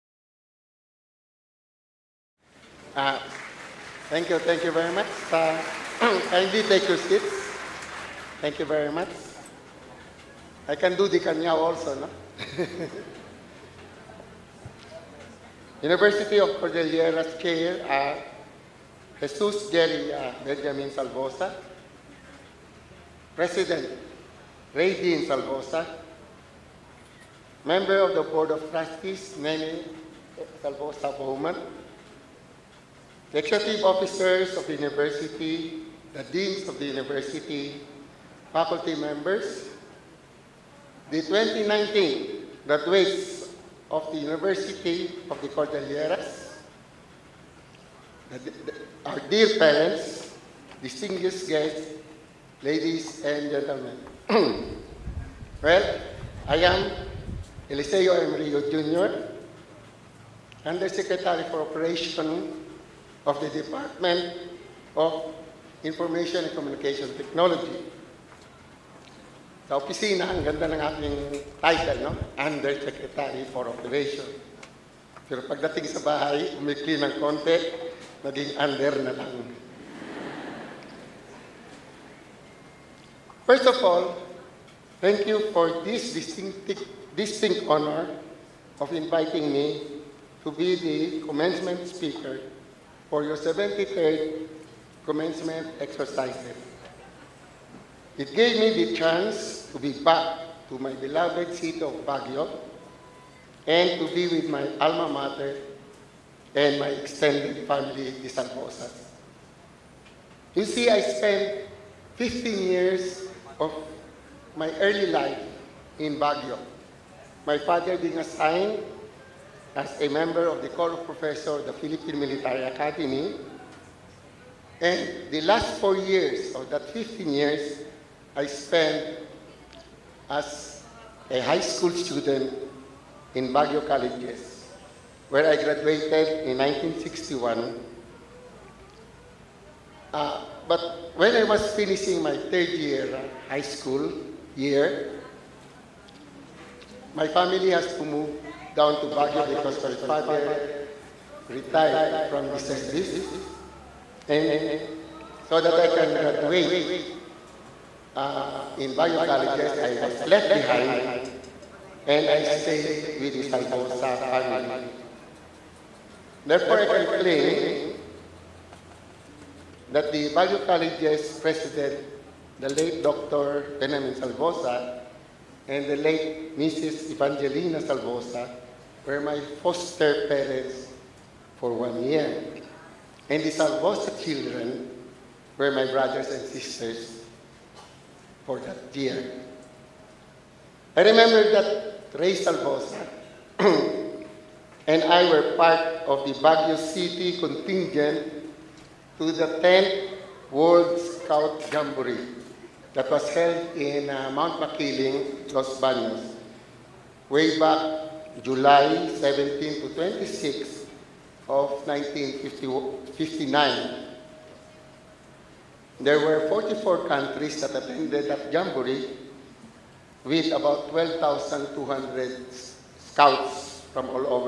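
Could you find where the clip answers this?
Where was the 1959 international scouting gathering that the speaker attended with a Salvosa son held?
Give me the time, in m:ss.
3:24.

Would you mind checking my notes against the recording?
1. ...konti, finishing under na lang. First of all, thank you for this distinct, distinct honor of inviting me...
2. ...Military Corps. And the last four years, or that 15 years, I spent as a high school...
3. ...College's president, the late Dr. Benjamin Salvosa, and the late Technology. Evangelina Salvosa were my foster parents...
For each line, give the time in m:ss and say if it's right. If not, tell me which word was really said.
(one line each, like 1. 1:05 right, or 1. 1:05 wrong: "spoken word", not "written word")
1. 1:17 wrong: "naging", not "finishing"
2. 2:02 wrong: "Academy", not "Corps"
3. 2:50 wrong: "Mrs", not "Technology".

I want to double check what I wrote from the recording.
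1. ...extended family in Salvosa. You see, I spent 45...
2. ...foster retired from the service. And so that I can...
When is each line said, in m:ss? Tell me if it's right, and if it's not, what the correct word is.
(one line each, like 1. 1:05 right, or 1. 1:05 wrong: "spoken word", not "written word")
1. 1:46 wrong: "15", not "45"
2. 2:30 wrong: "father", not "foster".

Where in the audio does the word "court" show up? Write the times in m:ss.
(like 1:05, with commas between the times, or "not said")
not said.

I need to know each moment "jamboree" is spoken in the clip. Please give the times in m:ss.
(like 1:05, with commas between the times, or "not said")
3:21, 3:38.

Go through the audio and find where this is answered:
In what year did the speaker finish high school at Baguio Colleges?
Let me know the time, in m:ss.
2:16.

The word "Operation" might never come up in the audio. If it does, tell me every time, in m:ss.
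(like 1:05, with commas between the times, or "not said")
1:01, 1:13.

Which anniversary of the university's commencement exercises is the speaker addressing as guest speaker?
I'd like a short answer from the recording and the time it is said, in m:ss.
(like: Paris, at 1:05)
73rd, at 1:33.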